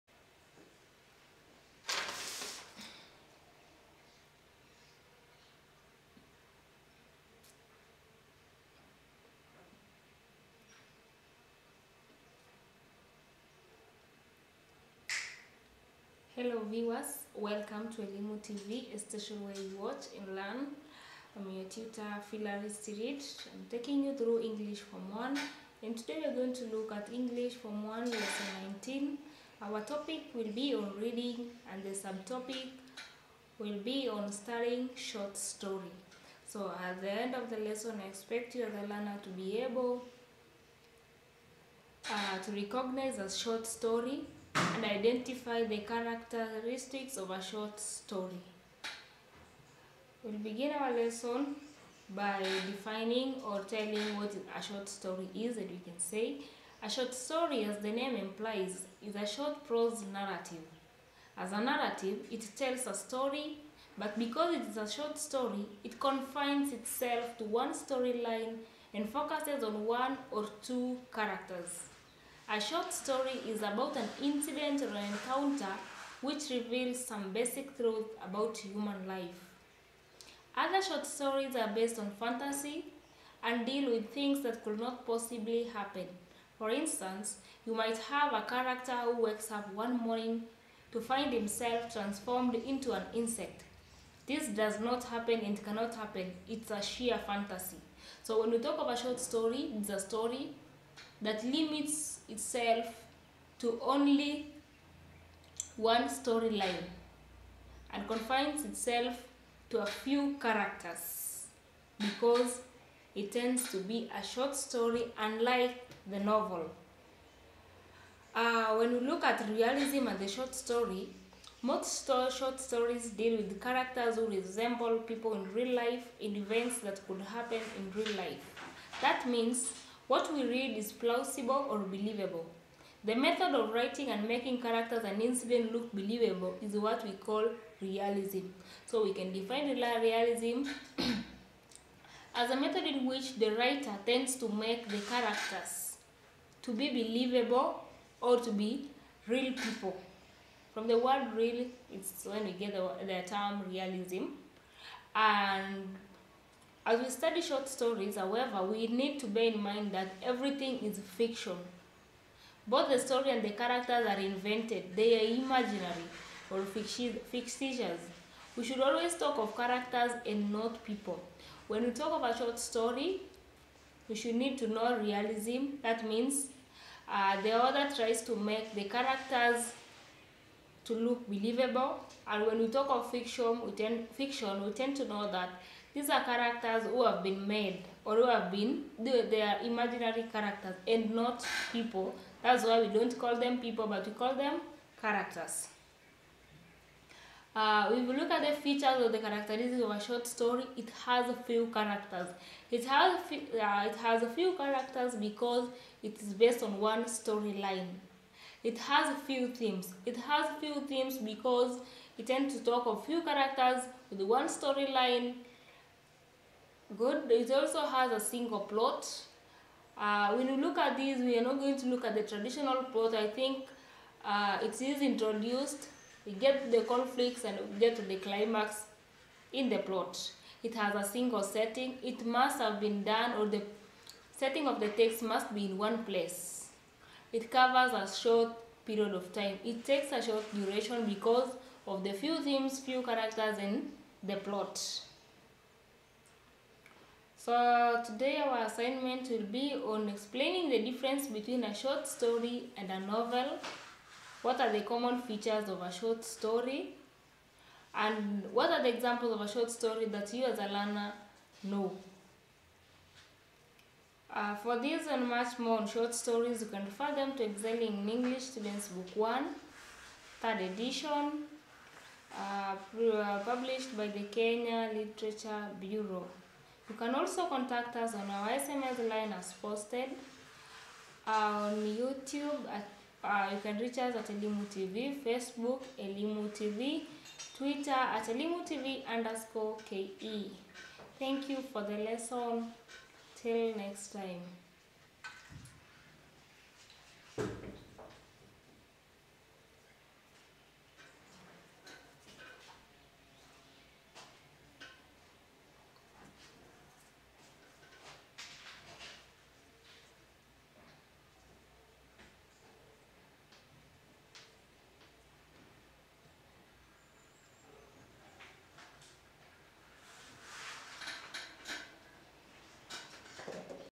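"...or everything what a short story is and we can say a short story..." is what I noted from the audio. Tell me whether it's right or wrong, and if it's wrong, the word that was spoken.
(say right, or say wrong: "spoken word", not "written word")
wrong: "telling", not "everything".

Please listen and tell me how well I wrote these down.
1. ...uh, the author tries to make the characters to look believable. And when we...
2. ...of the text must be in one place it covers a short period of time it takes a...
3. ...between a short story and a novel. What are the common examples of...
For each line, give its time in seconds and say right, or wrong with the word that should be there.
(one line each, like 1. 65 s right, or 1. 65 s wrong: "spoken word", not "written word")
1. 177 s right
2. 234 s right
3. 251 s wrong: "features", not "examples".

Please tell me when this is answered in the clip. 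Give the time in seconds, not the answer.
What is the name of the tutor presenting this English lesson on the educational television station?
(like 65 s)
22 s.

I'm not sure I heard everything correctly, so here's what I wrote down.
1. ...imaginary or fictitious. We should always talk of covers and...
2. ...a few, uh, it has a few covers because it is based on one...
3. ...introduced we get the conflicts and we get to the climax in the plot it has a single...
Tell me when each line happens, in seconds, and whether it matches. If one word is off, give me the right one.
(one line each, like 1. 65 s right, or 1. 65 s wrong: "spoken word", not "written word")
1. 165 s wrong: "characters", not "covers"
2. 203 s wrong: "characters", not "covers"
3. 225 s right.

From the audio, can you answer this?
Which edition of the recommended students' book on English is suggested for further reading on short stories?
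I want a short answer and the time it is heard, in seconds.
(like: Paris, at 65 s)
third edition, at 270 s.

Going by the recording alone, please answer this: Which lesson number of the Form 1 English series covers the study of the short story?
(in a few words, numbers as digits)
19.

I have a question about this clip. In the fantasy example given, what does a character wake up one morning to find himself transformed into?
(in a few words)
an insect.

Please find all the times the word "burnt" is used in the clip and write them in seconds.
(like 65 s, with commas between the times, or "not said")
not said.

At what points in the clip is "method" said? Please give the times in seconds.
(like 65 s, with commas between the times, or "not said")
133 s, 142 s.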